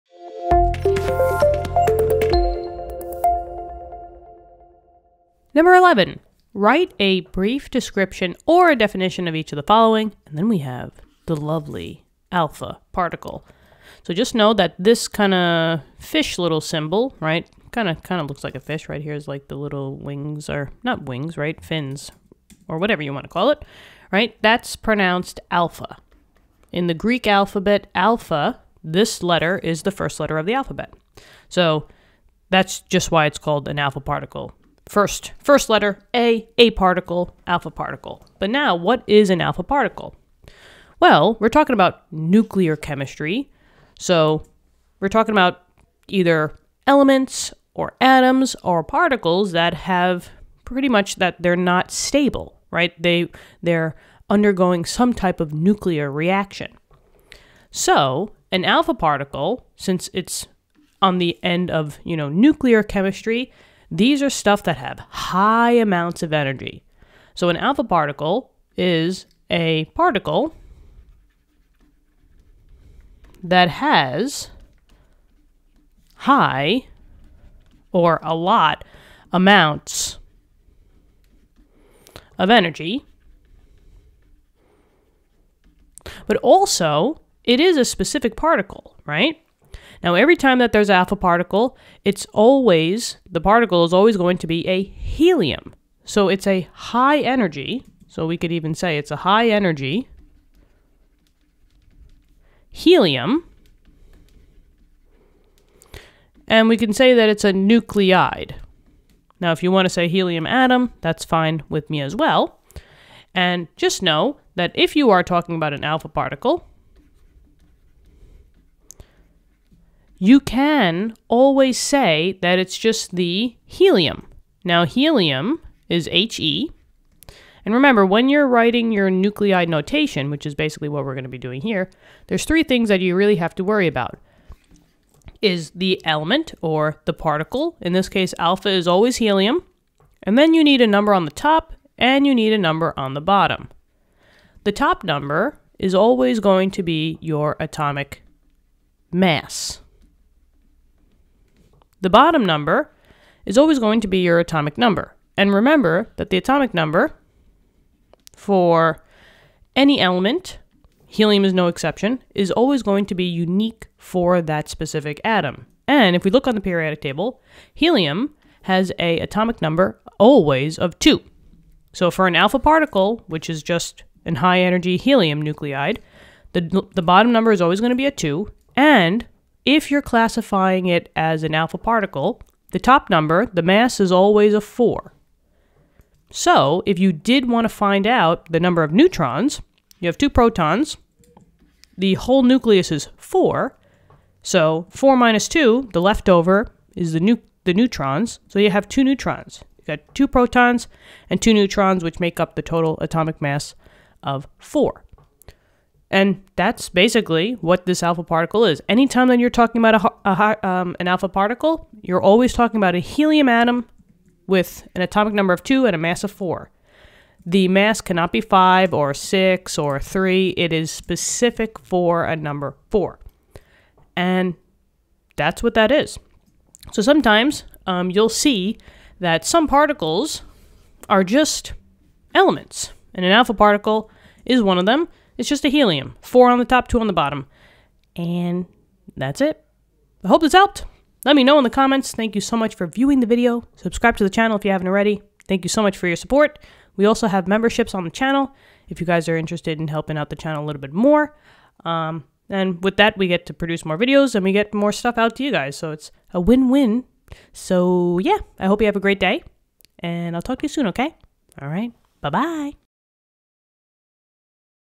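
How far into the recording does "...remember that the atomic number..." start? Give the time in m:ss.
2:35.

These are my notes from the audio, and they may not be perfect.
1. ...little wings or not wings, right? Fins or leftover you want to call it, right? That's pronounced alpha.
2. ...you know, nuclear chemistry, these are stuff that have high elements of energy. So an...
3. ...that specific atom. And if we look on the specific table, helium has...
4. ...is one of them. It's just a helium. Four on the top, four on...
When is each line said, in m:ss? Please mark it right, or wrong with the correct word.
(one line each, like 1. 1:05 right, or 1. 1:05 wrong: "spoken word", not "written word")
1. 0:19 wrong: "whatever", not "leftover"
2. 1:02 wrong: "amounts", not "elements"
3. 2:44 wrong: "periodic", not "specific"
4. 3:54 wrong: "two", not "four".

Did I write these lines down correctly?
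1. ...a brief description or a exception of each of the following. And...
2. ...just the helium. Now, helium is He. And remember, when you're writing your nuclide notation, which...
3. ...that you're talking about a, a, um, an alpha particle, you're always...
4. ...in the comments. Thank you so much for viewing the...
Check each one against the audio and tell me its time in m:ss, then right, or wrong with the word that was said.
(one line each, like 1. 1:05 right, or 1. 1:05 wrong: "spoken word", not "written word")
1. 0:06 wrong: "definition", not "exception"
2. 2:02 right
3. 3:29 right
4. 4:01 right.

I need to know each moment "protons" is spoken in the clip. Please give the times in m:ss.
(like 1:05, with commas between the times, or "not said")
3:10, 3:20.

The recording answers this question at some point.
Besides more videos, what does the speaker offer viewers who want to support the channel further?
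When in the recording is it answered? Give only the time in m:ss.
4:07.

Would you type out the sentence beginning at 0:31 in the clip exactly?
So that's just why it's called an alpha particle First, first letter A, A particle, alpha particle.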